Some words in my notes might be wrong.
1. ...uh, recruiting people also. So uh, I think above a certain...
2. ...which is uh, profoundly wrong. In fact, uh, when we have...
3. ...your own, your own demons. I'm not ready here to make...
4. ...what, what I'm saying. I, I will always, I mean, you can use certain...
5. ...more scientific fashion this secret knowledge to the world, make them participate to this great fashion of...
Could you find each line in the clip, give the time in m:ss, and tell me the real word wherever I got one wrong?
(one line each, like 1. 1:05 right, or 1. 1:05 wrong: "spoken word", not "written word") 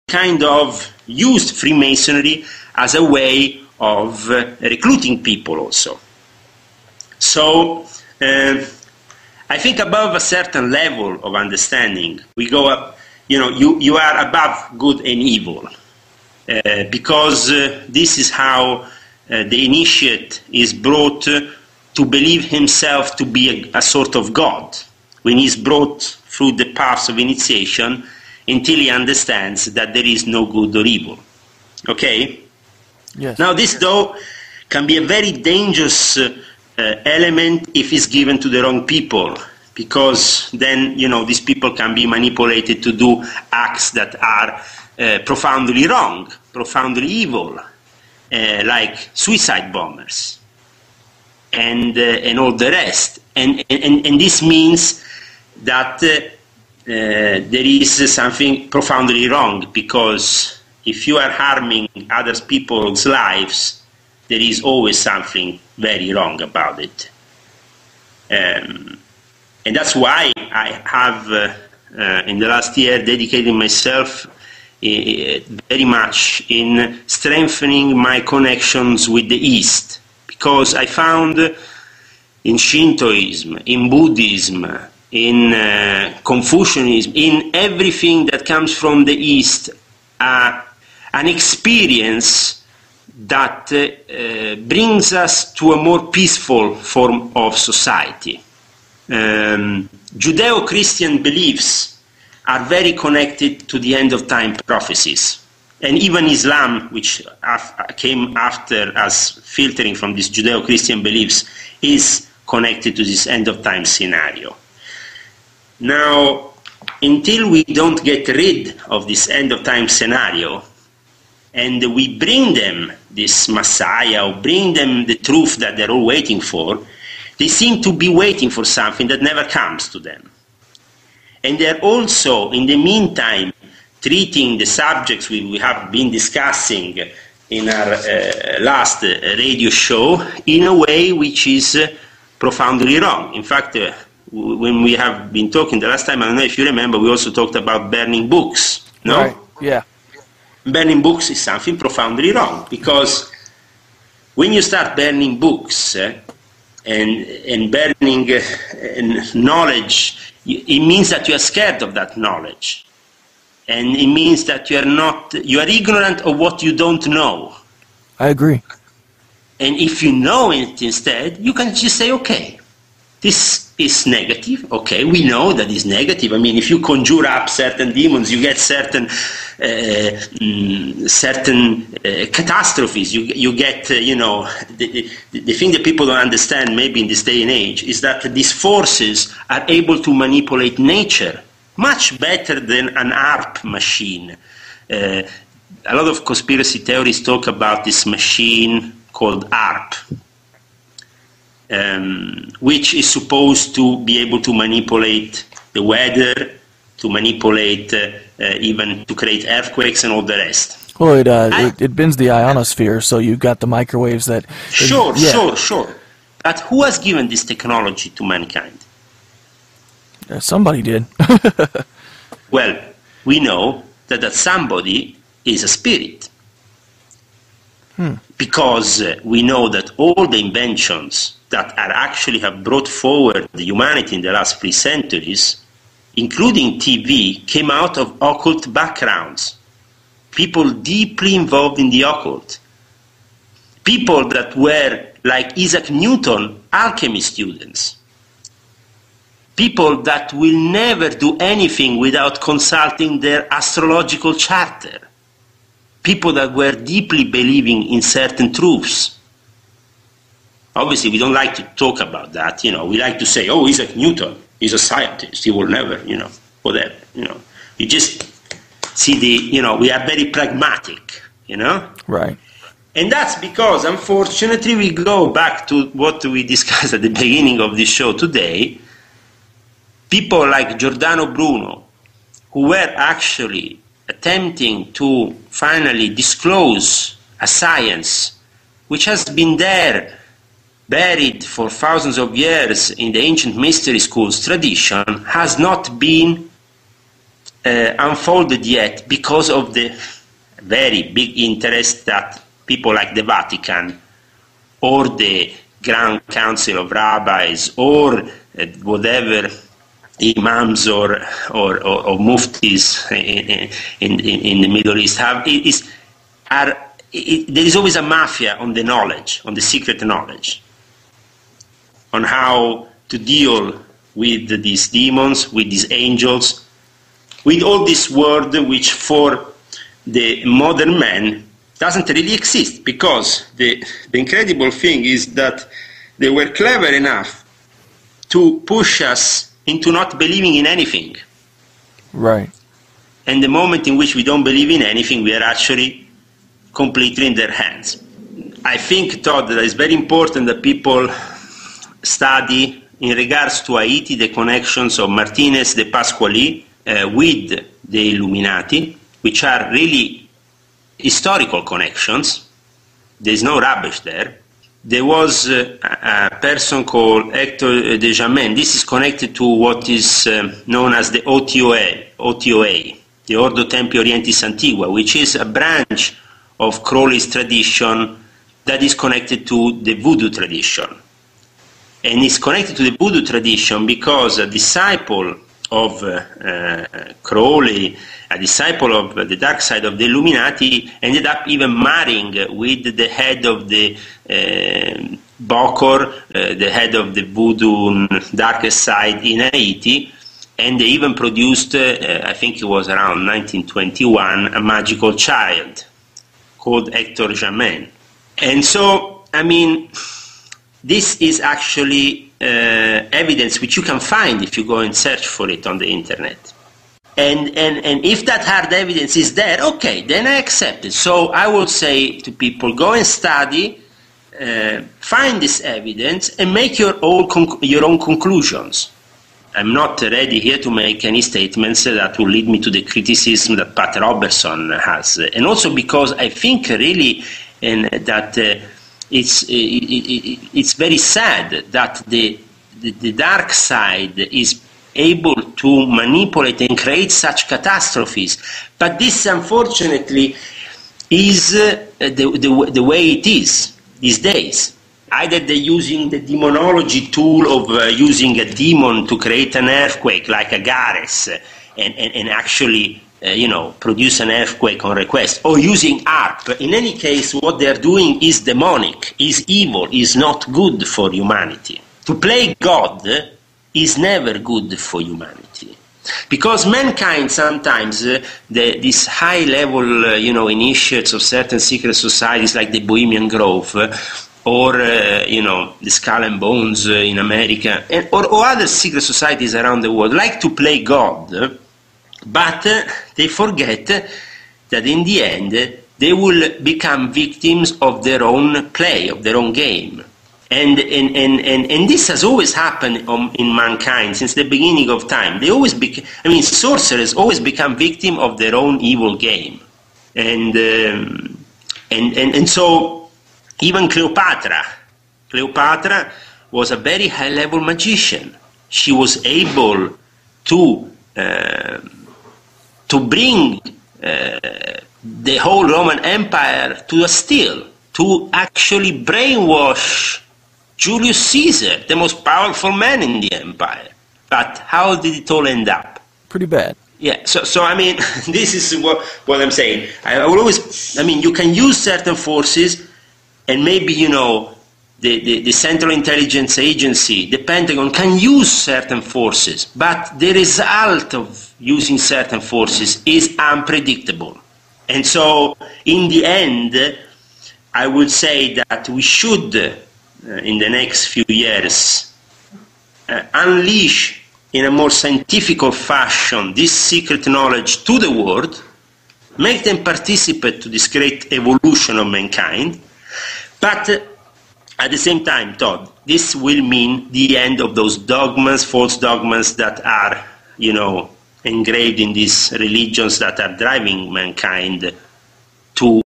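1. 0:04 right
2. 2:21 right
3. 7:06 wrong: "conclusions", not "demons"
4. 8:58 right
5. 9:24 wrong: "evolution", not "fashion".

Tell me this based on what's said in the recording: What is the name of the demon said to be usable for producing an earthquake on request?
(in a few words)
Agares.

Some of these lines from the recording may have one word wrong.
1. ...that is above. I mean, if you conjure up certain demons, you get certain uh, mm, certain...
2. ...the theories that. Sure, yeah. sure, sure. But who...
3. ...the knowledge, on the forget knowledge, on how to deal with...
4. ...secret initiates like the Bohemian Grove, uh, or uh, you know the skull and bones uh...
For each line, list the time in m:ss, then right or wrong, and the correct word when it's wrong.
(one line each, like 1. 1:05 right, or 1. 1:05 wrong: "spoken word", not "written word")
1. 2:55 wrong: "negative", not "above"
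2. 3:33 wrong: "microwaves", not "theories"
3. 5:18 wrong: "secret", not "forget"
4. 8:01 wrong: "societies", not "initiates".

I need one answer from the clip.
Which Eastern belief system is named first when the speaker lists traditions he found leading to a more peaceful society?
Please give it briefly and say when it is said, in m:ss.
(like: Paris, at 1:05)
Shintoism, at 1:22.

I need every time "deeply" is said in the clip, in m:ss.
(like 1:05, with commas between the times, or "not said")
4:00, 4:16.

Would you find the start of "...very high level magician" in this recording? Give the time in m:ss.
8:36.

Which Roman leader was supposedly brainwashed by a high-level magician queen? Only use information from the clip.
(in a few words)
Julius Caesar.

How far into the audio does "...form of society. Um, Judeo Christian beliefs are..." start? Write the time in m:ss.
1:36.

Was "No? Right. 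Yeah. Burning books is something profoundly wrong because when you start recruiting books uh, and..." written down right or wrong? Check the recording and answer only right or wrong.
wrong.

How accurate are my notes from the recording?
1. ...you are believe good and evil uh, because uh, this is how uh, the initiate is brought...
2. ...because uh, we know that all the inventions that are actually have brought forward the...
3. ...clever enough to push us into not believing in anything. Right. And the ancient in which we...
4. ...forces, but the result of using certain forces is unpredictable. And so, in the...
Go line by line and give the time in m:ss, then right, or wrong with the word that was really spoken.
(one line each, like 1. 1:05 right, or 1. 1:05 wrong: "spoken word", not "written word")
1. 0:13 wrong: "above", not "believe"
2. 3:48 right
3. 5:36 wrong: "moment", not "ancient"
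4. 9:09 right.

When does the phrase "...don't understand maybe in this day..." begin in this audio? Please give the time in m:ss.
3:06.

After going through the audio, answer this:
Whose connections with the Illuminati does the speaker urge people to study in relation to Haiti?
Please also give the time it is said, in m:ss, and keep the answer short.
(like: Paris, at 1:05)
Martinez de Pasqually, at 5:55.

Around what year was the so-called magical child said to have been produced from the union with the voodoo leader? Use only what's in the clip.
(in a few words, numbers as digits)
1921.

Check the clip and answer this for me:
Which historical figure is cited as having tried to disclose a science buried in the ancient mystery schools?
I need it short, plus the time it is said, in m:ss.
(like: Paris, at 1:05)
Giordano Bruno, at 4:40.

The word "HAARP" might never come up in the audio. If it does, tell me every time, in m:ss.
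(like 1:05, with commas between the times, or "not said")
3:13, 3:19, 7:46.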